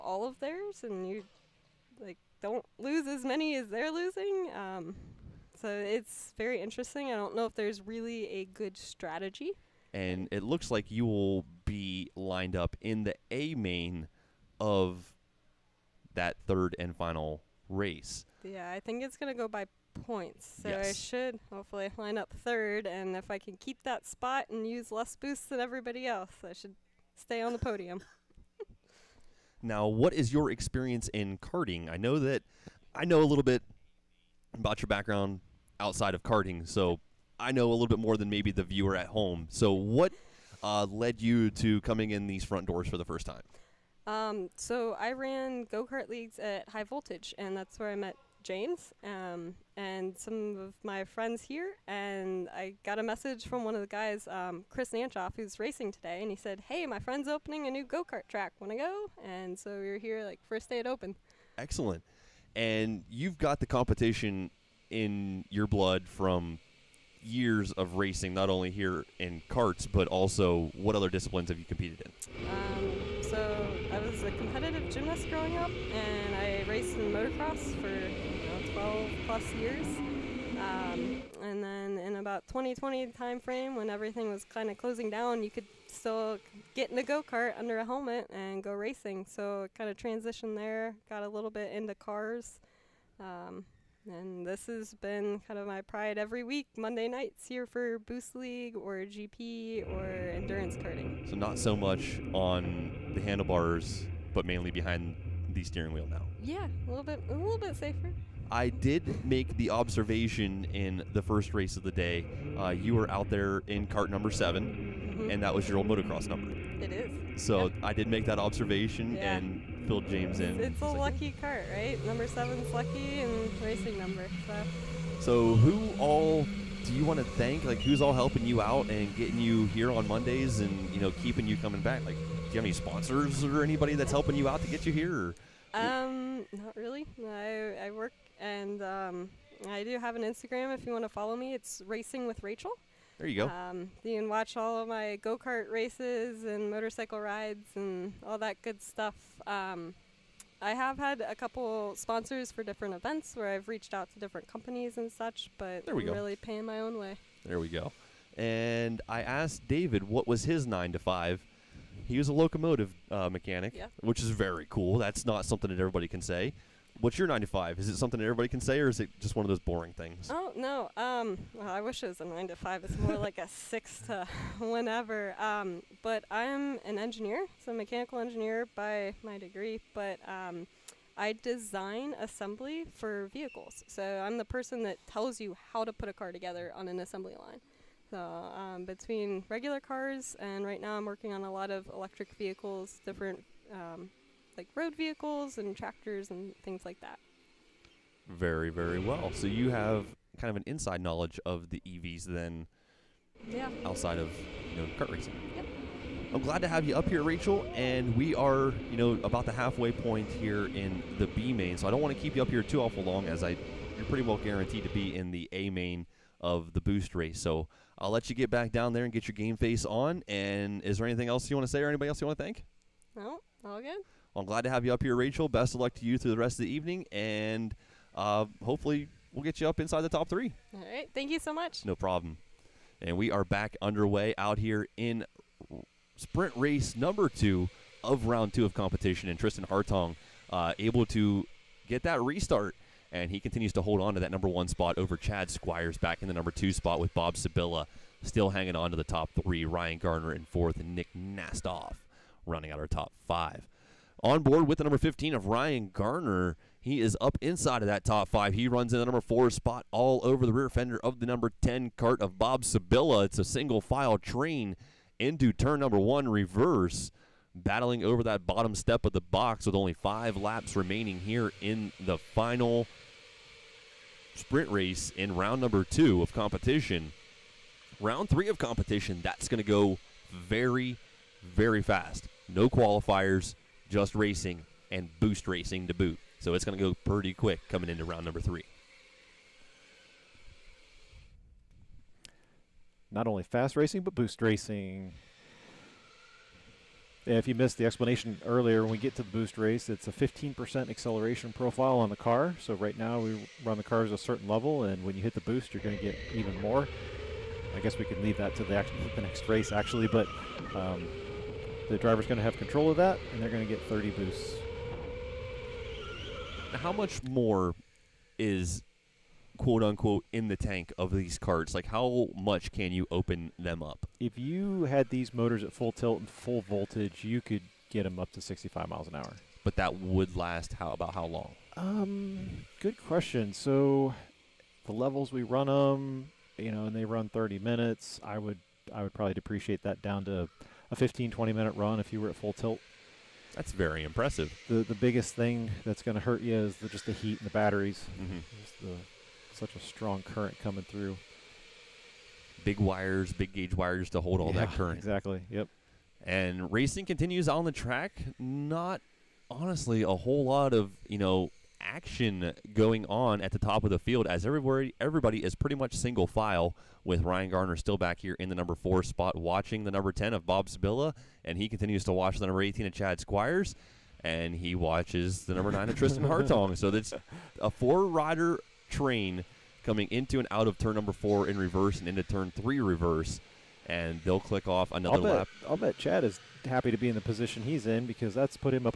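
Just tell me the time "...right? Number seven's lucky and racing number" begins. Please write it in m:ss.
2:01.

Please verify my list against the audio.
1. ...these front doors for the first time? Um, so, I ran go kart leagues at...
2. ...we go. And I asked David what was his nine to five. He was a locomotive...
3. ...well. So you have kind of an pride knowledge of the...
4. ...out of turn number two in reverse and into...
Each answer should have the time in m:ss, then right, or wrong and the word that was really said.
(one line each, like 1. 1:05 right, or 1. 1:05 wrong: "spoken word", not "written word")
1. 0:42 right
2. 2:37 right
3. 3:18 wrong: "inside", not "pride"
4. 6:20 wrong: "four", not "two".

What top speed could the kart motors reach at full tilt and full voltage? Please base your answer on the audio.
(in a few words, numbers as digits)
65 miles an hour.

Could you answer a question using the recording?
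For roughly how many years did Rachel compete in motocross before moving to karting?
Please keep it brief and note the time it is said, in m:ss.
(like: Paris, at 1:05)
12 plus years, at 1:18.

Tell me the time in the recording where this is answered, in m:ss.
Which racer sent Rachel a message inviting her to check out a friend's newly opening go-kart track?
0:54.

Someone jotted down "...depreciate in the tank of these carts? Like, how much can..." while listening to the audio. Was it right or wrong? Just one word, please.
wrong.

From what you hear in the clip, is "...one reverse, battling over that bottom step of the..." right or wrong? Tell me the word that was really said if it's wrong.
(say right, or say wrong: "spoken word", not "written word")
right.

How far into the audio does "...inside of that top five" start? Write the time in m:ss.
4:17.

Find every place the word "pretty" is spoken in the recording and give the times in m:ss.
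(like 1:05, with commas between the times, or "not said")
3:34, 4:47, 6:05.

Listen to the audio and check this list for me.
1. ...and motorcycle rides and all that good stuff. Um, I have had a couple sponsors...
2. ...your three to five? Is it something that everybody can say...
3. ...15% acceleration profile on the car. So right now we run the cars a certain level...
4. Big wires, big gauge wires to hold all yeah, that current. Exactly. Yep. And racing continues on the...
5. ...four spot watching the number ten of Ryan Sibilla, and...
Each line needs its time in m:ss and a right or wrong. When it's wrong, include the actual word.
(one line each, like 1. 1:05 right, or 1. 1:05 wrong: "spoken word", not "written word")
1. 2:26 right
2. 2:47 wrong: "nine", not "three"
3. 5:00 right
4. 5:52 right
5. 6:08 wrong: "Bob", not "Ryan".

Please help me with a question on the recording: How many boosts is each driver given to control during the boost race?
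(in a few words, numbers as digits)
30.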